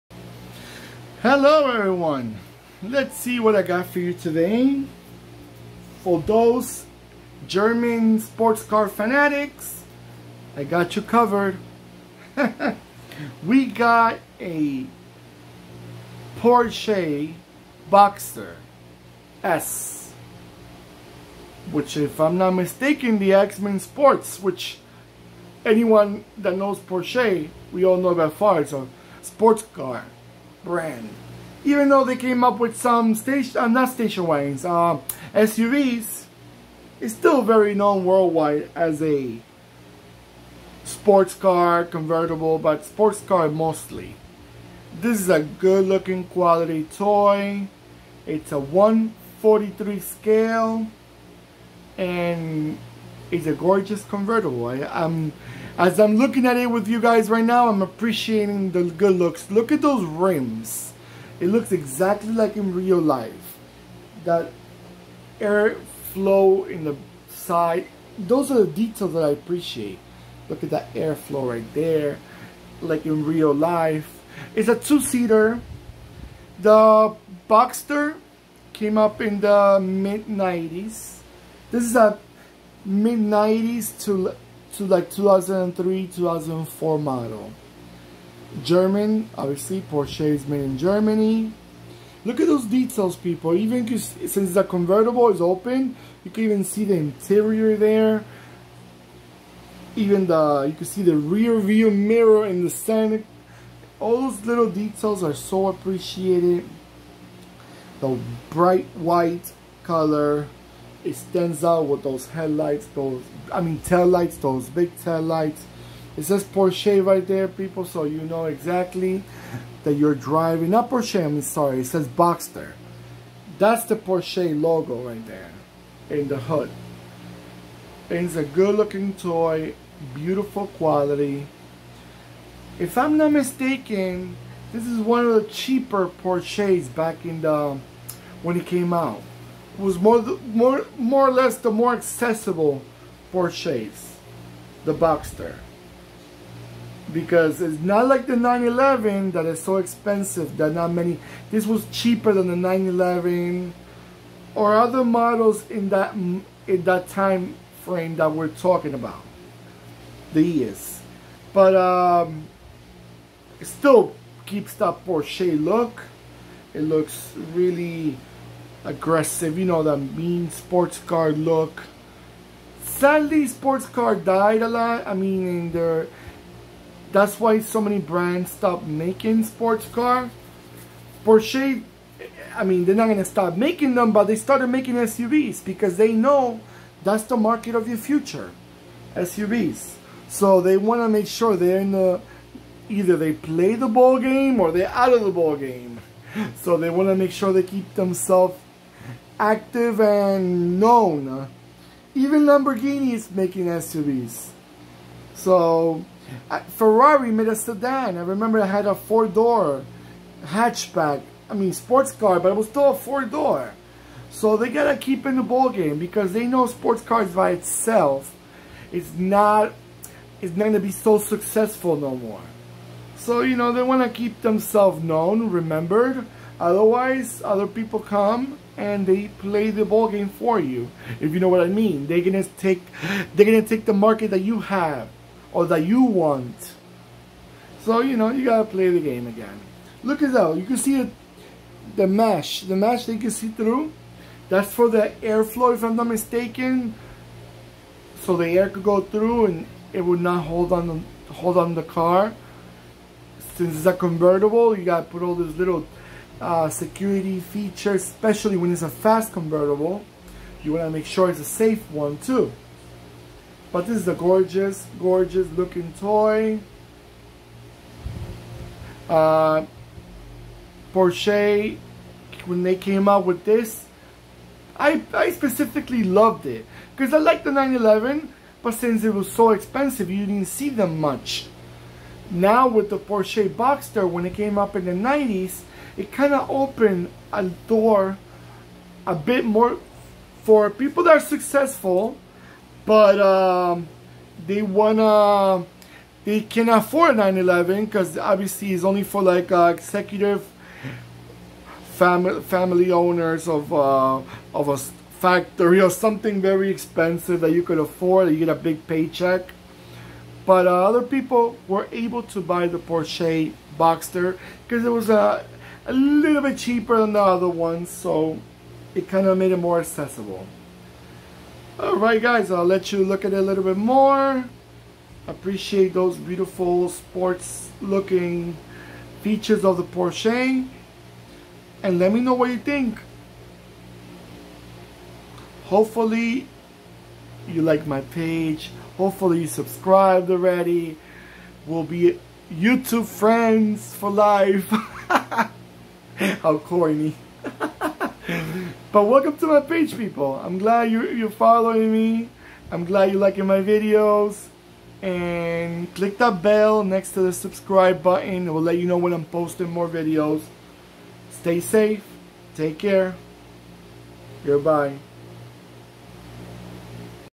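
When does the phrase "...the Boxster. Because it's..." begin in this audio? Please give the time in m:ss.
2:24.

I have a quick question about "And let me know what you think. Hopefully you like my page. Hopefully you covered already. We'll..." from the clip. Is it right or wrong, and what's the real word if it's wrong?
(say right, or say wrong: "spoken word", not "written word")
wrong: "subscribed", not "covered".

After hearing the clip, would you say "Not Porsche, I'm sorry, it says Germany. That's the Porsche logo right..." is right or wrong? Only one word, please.
wrong.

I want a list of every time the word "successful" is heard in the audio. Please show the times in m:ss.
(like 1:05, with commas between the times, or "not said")
3:41, 4:51.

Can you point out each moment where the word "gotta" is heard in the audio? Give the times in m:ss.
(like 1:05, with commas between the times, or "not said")
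3:34, 3:58, 4:14.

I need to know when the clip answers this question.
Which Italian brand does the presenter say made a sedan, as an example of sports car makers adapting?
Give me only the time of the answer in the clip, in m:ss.
3:26.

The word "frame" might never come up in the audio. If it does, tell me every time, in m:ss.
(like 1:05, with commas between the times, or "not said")
2:37.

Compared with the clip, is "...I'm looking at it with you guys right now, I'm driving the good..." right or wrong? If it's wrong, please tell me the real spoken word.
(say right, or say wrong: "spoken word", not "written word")
wrong: "appreciating", not "driving".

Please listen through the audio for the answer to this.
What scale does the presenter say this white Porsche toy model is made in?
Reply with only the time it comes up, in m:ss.
0:48.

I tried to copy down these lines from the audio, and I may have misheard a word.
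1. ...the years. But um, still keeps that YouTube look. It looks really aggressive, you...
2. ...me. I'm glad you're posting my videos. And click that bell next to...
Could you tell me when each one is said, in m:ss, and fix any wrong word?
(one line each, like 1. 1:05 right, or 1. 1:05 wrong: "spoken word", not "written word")
1. 2:40 wrong: "Porsche", not "YouTube"
2. 5:51 wrong: "liking", not "posting".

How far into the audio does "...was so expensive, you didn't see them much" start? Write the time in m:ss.
4:39.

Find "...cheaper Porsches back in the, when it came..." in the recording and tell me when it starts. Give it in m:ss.
2:15.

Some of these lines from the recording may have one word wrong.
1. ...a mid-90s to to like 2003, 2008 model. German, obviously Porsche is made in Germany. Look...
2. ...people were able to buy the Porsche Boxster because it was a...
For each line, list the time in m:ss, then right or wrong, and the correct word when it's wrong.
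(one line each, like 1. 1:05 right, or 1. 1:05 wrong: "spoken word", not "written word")
1. 1:21 wrong: "2004", not "2008"
2. 5:11 right.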